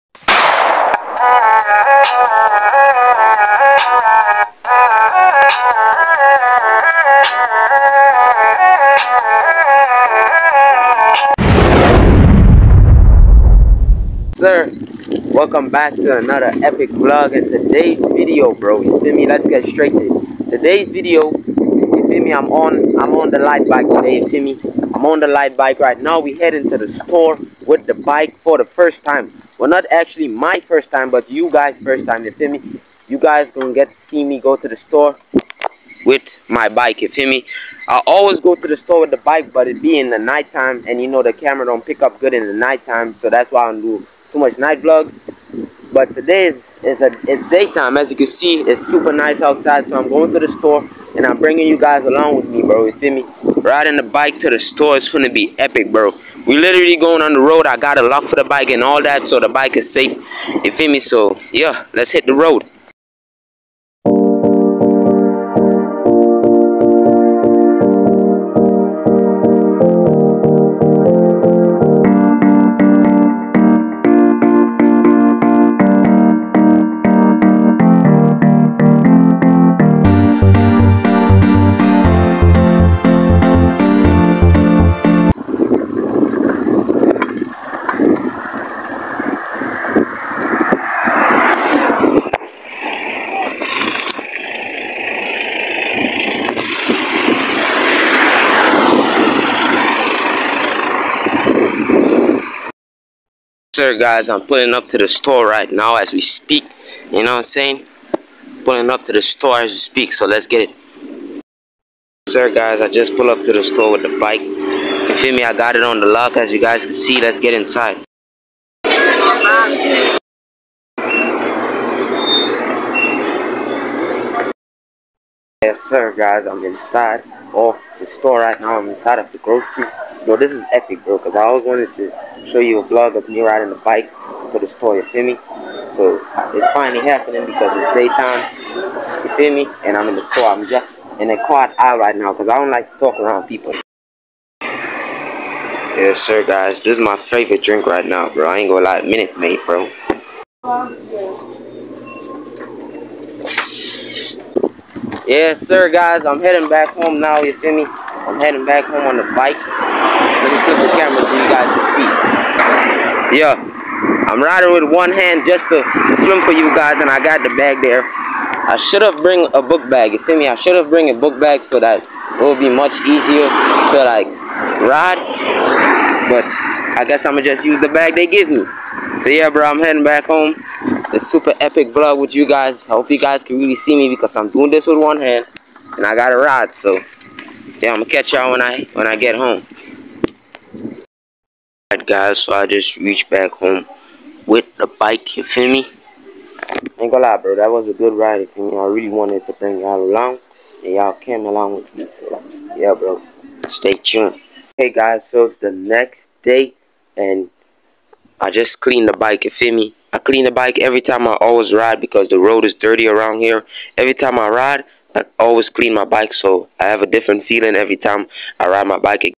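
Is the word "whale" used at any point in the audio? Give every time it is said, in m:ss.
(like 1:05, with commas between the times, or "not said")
not said.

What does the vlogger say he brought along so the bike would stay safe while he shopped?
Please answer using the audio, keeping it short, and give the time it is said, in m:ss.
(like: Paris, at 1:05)
a lock, at 0:57.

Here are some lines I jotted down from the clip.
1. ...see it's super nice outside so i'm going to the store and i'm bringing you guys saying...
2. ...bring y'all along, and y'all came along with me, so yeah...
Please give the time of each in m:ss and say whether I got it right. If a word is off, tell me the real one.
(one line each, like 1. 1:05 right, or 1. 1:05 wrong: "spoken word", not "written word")
1. 0:48 wrong: "along", not "saying"
2. 3:19 right.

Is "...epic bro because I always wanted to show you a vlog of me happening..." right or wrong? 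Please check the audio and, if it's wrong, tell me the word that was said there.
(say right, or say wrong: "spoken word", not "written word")
wrong: "riding", not "happening".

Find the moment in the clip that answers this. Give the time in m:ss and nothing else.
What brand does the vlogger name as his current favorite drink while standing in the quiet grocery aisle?
2:29.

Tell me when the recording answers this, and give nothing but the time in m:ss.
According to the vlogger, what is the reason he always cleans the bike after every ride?
3:32.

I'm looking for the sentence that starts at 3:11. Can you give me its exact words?
Alright guys, so I just reached back home with the bike, you feel me?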